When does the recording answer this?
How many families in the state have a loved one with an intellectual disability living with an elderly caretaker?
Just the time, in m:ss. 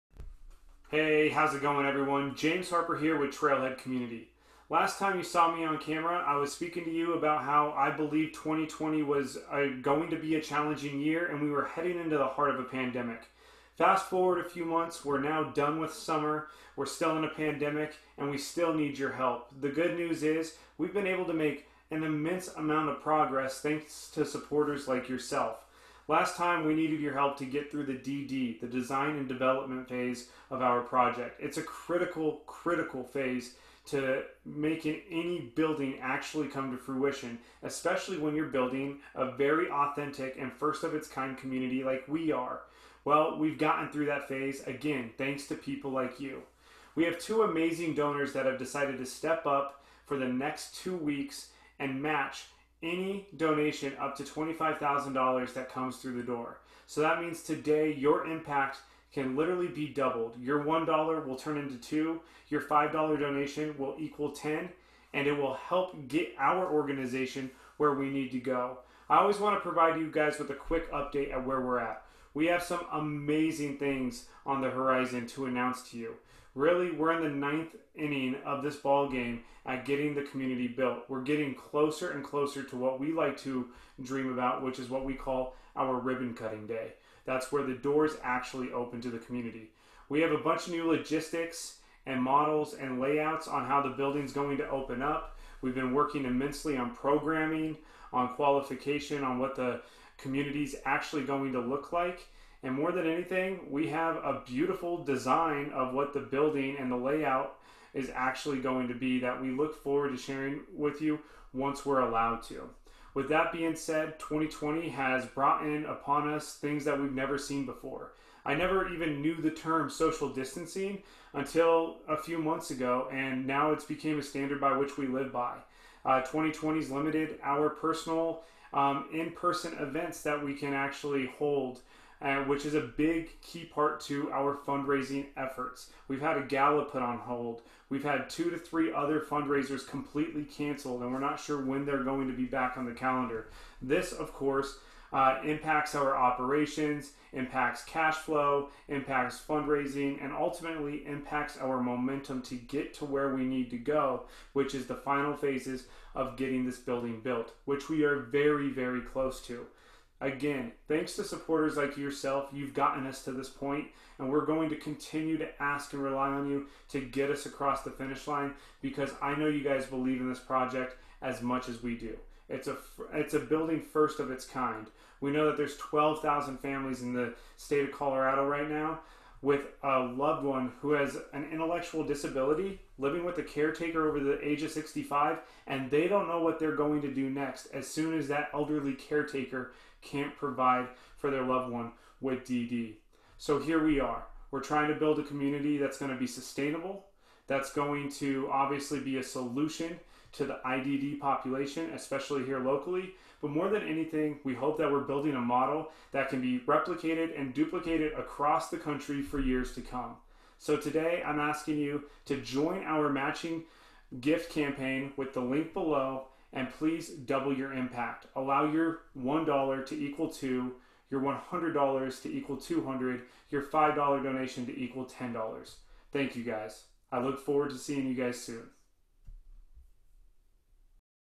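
2:55.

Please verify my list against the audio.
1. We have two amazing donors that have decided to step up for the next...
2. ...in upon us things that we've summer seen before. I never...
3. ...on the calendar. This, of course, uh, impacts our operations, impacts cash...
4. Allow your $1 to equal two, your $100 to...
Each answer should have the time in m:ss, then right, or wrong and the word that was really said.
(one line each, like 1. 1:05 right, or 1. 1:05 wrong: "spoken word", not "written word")
1. 0:46 right
2. 1:55 wrong: "never", not "summer"
3. 2:22 right
4. 3:38 right.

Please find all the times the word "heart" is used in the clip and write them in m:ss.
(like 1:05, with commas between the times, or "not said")
0:12.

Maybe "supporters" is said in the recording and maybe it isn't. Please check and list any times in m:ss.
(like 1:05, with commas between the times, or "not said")
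0:24, 2:41.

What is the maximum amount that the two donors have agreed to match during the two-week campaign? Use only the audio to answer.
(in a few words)
$25,000.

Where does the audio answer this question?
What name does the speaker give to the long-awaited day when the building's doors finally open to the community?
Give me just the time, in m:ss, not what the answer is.
1:25.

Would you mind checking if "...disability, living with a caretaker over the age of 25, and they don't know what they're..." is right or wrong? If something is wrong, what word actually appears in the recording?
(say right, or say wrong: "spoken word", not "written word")
wrong: "65", not "25".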